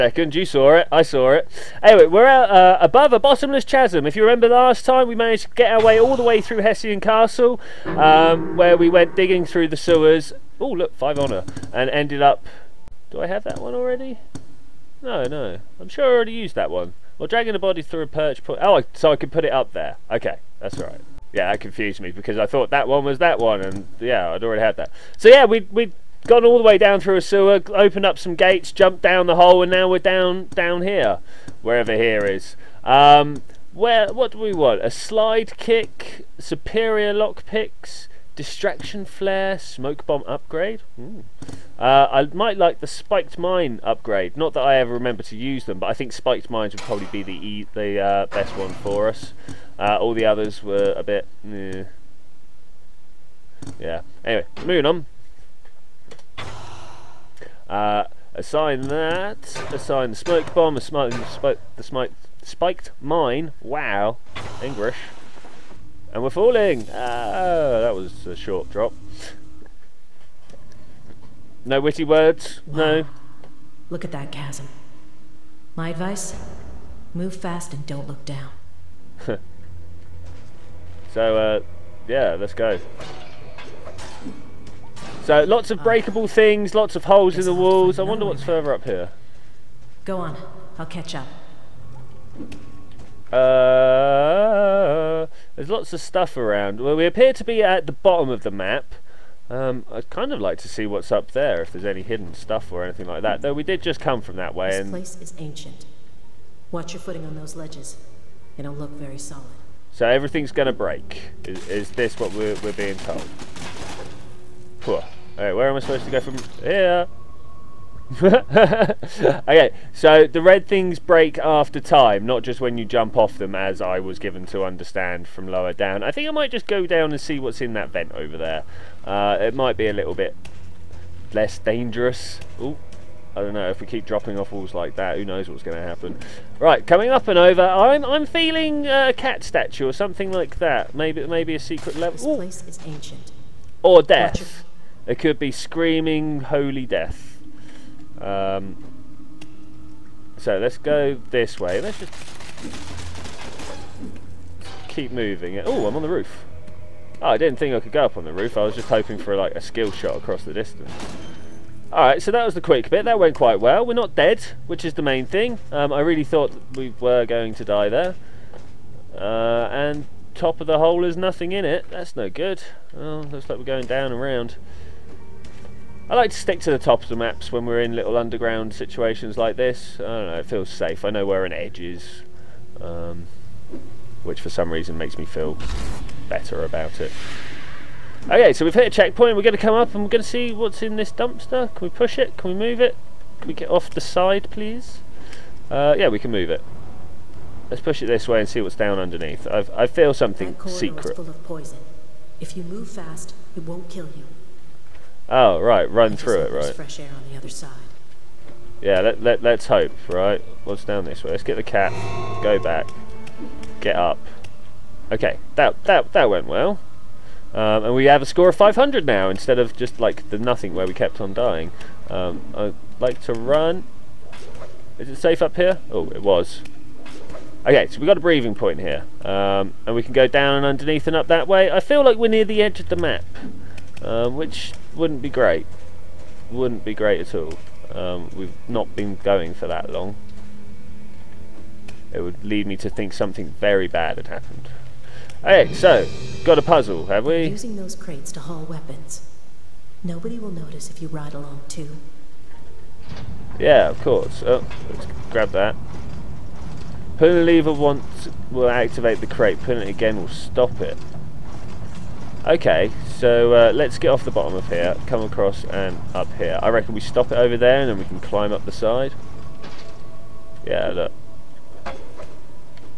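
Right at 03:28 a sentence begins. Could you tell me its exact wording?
Yeah, let, let, let's hope, right?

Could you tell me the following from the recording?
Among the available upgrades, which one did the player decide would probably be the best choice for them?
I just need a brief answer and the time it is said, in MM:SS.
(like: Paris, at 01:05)
Spiked mine upgrade, at 00:42.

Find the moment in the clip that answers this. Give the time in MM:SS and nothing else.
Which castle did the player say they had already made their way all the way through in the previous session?
00:06.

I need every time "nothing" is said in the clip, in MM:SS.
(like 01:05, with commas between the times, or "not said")
02:51, 03:40.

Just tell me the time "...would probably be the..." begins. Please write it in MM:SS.
00:46.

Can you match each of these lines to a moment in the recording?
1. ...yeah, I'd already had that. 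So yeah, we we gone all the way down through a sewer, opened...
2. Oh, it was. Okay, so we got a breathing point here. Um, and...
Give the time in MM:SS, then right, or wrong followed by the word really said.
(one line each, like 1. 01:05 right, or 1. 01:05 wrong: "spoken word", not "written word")
1. 00:23 right
2. 03:45 right.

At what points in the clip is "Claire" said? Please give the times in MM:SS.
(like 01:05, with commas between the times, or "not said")
not said.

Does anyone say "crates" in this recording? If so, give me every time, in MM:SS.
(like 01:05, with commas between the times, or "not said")
04:07, 04:19.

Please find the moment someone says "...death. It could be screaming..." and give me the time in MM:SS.
02:24.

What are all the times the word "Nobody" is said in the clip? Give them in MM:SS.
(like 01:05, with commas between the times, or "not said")
04:10.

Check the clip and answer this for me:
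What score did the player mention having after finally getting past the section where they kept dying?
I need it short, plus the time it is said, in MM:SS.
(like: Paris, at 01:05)
500, at 03:38.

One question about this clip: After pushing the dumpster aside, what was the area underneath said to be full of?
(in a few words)
Poison.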